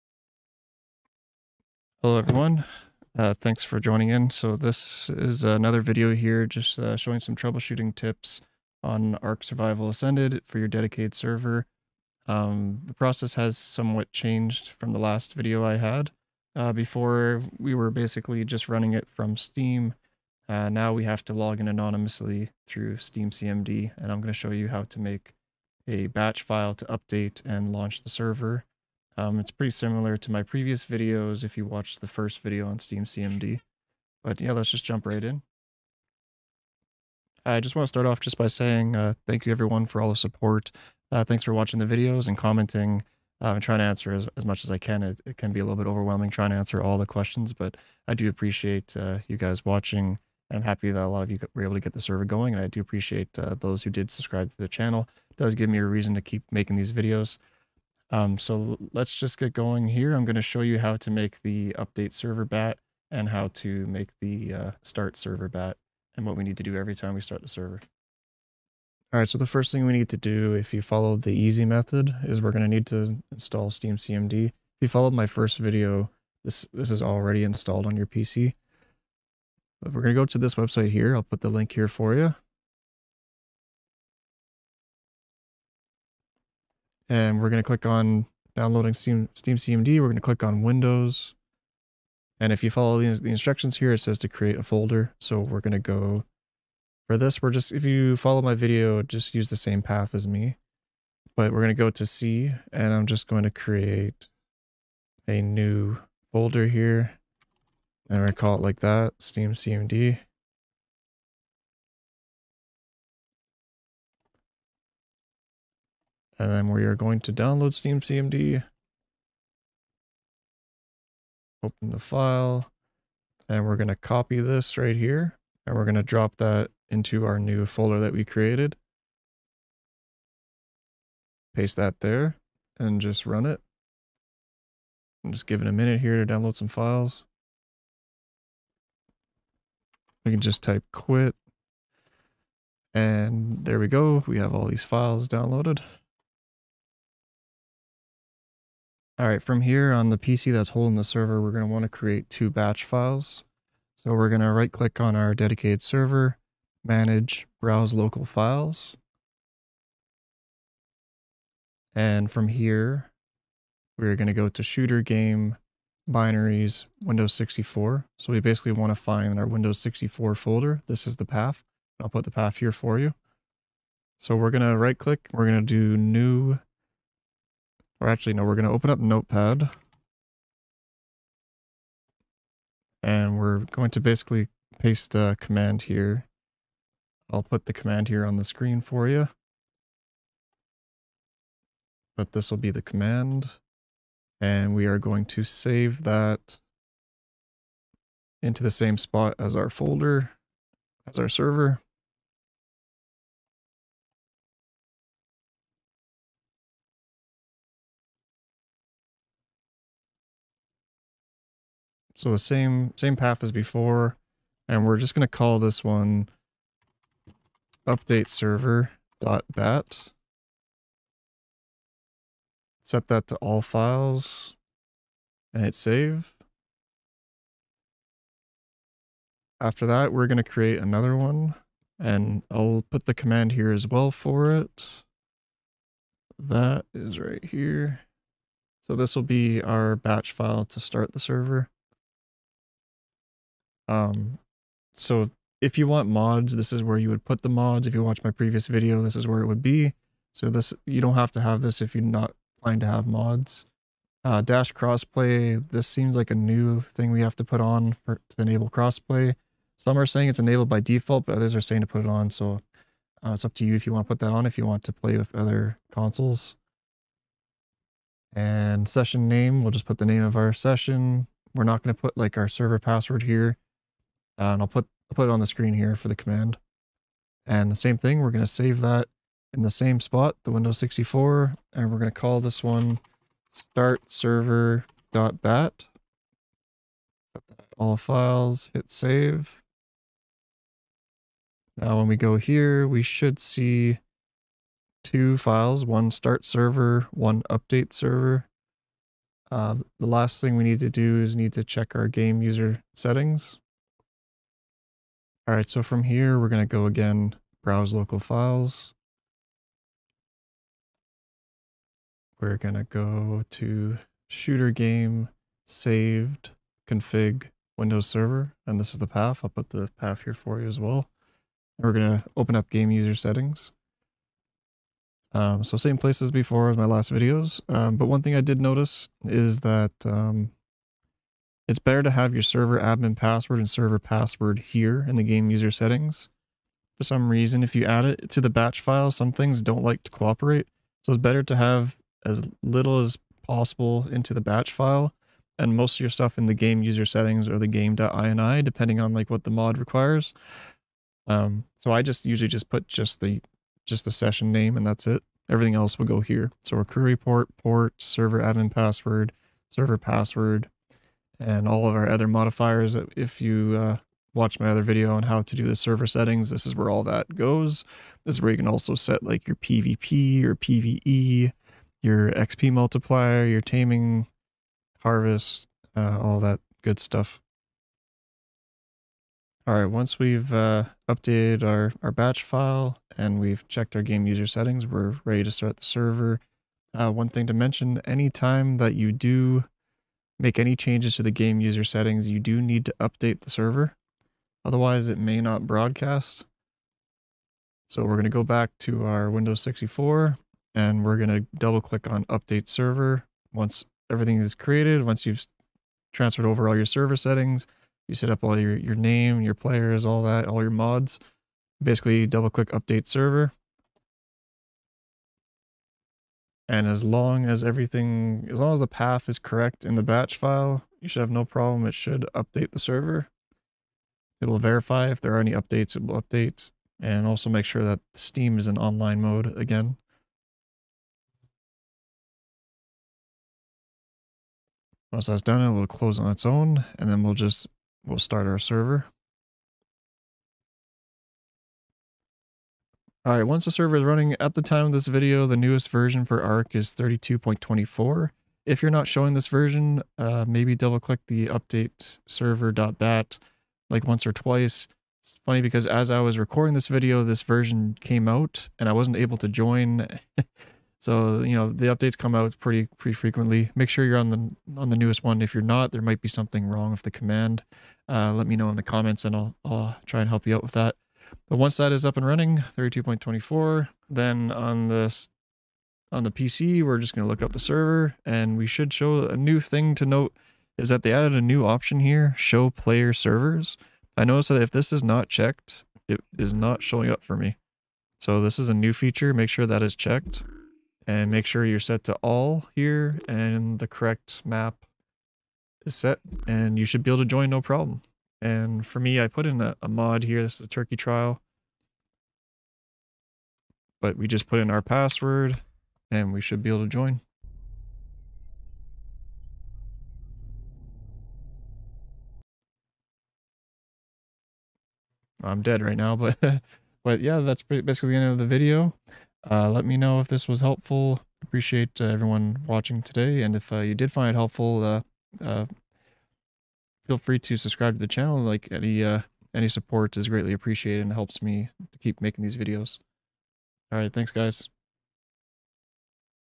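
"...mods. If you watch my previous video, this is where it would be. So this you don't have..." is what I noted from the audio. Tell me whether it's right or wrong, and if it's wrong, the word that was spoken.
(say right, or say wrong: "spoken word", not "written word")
right.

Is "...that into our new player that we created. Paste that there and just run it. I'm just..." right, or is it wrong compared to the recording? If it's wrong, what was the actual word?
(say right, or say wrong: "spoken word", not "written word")
wrong: "folder", not "player".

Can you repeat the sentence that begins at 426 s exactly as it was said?
And also make sure that Steam is in online mode again.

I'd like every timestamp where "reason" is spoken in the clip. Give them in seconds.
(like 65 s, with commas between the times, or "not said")
55 s, 337 s.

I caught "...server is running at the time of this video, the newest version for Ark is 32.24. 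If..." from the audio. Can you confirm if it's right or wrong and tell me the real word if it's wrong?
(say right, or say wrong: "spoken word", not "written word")
right.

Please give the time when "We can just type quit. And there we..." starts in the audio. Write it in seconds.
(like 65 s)
140 s.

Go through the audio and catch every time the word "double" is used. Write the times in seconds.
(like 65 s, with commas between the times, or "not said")
401 s, 412 s, 450 s.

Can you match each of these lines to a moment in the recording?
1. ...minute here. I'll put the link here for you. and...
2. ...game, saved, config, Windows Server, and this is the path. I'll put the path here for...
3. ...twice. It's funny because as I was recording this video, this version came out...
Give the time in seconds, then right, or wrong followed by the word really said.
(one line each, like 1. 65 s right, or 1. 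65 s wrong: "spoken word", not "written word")
1. 80 s wrong: "website", not "minute"
2. 314 s right
3. 454 s right.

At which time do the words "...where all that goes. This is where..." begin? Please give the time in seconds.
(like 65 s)
366 s.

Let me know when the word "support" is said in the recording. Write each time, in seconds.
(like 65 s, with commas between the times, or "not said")
40 s, 529 s.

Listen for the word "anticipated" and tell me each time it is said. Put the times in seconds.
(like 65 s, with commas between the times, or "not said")
not said.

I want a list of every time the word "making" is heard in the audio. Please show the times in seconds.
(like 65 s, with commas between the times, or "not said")
56 s, 532 s.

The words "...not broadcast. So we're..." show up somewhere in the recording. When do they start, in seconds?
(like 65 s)
395 s.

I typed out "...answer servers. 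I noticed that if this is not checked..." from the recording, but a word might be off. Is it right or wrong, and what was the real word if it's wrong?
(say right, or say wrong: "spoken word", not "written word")
wrong: "player", not "answer".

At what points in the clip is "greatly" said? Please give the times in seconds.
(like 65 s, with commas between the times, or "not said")
530 s.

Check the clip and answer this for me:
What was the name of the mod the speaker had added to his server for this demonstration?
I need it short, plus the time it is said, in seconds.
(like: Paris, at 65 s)
turkey trial, at 500 s.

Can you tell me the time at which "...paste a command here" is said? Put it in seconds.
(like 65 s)
184 s.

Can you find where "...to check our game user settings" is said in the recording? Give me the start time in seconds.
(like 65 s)
301 s.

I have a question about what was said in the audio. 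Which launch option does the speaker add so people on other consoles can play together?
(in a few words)
dash crossplay.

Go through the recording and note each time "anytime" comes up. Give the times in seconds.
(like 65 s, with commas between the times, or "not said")
388 s.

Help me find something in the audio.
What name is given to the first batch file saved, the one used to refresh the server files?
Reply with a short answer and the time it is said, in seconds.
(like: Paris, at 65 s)
update server.bat, at 217 s.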